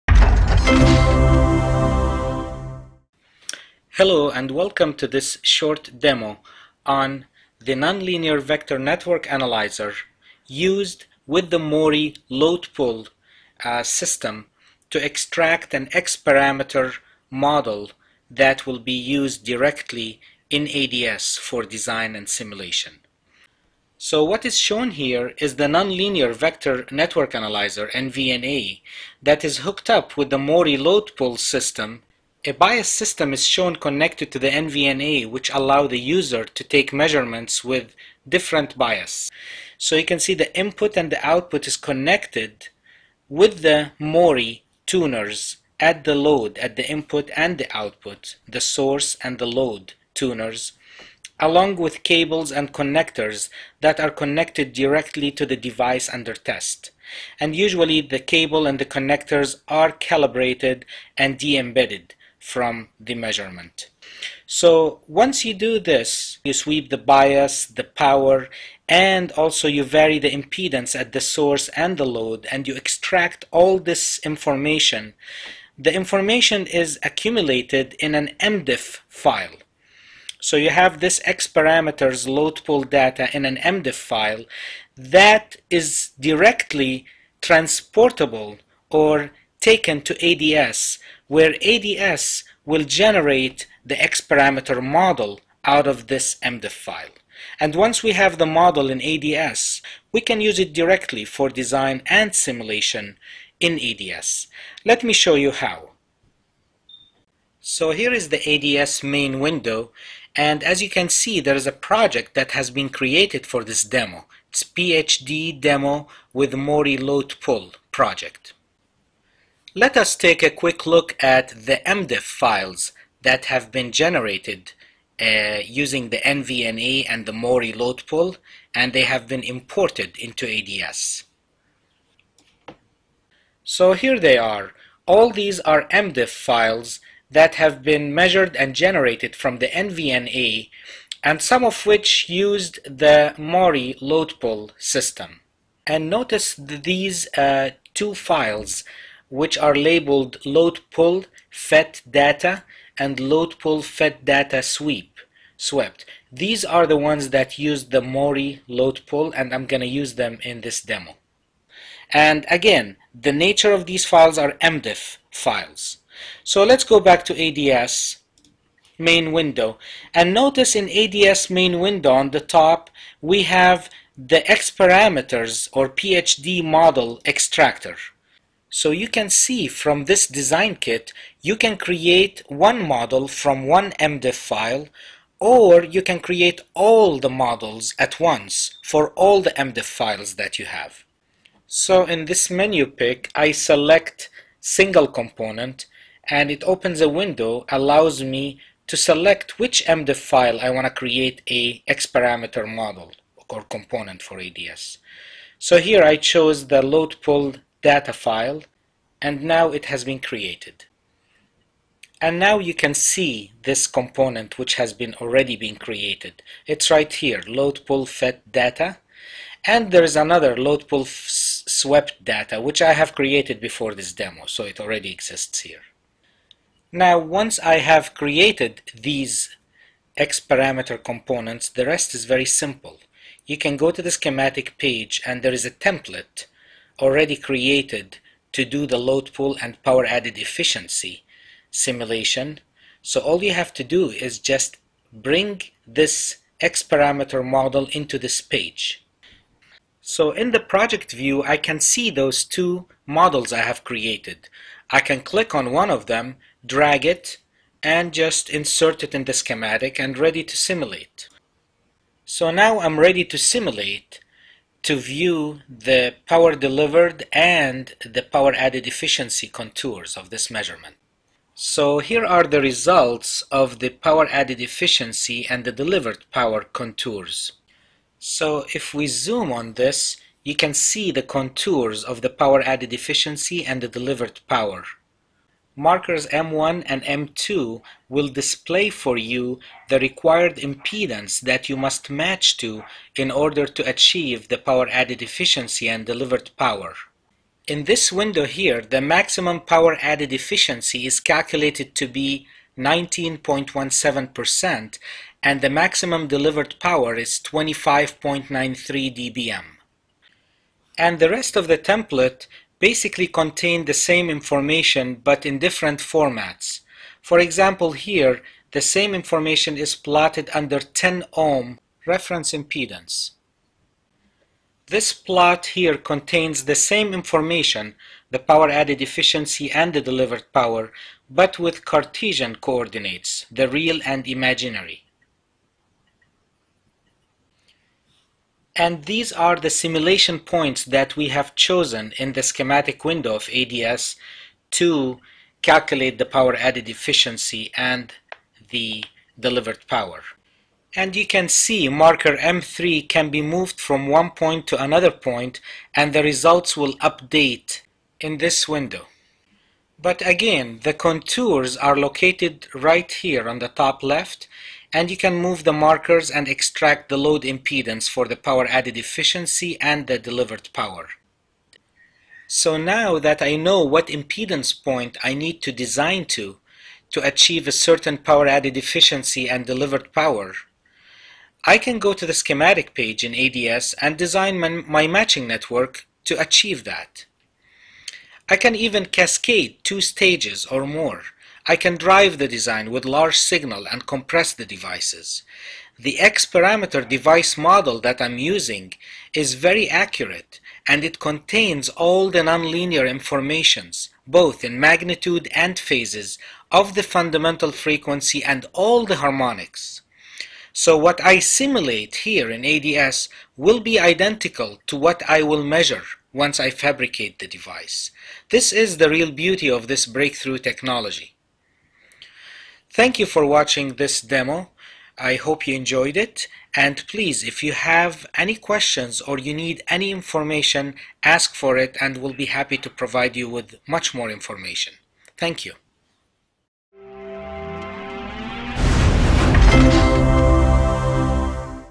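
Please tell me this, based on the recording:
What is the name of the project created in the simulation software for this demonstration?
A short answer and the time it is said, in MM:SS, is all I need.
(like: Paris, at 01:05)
PhD demo with Maury load pull, at 01:54.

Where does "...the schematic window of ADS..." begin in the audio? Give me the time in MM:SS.
05:42.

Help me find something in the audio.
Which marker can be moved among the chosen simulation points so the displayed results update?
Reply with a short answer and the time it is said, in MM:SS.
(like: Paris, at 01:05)
M3, at 05:52.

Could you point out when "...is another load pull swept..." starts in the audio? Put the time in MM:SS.
03:40.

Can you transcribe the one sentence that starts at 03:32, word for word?
And now you can see this component which has been already been created.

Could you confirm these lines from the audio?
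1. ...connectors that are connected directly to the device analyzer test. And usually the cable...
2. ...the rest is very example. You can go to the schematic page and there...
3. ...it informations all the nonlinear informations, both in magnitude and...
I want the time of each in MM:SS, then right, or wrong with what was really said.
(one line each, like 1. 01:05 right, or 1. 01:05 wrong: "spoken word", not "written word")
1. 00:52 wrong: "under", not "analyzer"
2. 03:51 wrong: "simple", not "example"
3. 06:41 wrong: "contains", not "informations".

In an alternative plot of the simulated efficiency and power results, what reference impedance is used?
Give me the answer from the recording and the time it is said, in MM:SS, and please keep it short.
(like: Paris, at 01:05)
10 ohm, at 05:20.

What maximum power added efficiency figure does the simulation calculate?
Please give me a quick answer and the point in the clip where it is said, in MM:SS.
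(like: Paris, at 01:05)
19.17%, at 05:02.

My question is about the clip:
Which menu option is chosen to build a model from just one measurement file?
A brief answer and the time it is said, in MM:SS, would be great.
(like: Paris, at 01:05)
Single component, at 03:14.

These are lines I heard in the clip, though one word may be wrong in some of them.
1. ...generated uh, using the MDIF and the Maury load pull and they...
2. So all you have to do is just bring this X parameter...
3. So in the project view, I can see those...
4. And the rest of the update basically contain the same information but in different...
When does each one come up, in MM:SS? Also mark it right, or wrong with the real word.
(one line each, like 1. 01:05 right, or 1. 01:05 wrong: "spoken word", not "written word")
1. 02:03 wrong: "NVNA", not "MDIF"
2. 04:03 right
3. 04:10 right
4. 05:10 wrong: "template", not "update".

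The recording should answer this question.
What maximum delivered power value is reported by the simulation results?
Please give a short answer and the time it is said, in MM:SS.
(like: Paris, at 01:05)
25.93 dBm, at 05:07.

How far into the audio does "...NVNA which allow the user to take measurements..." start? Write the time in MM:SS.
00:34.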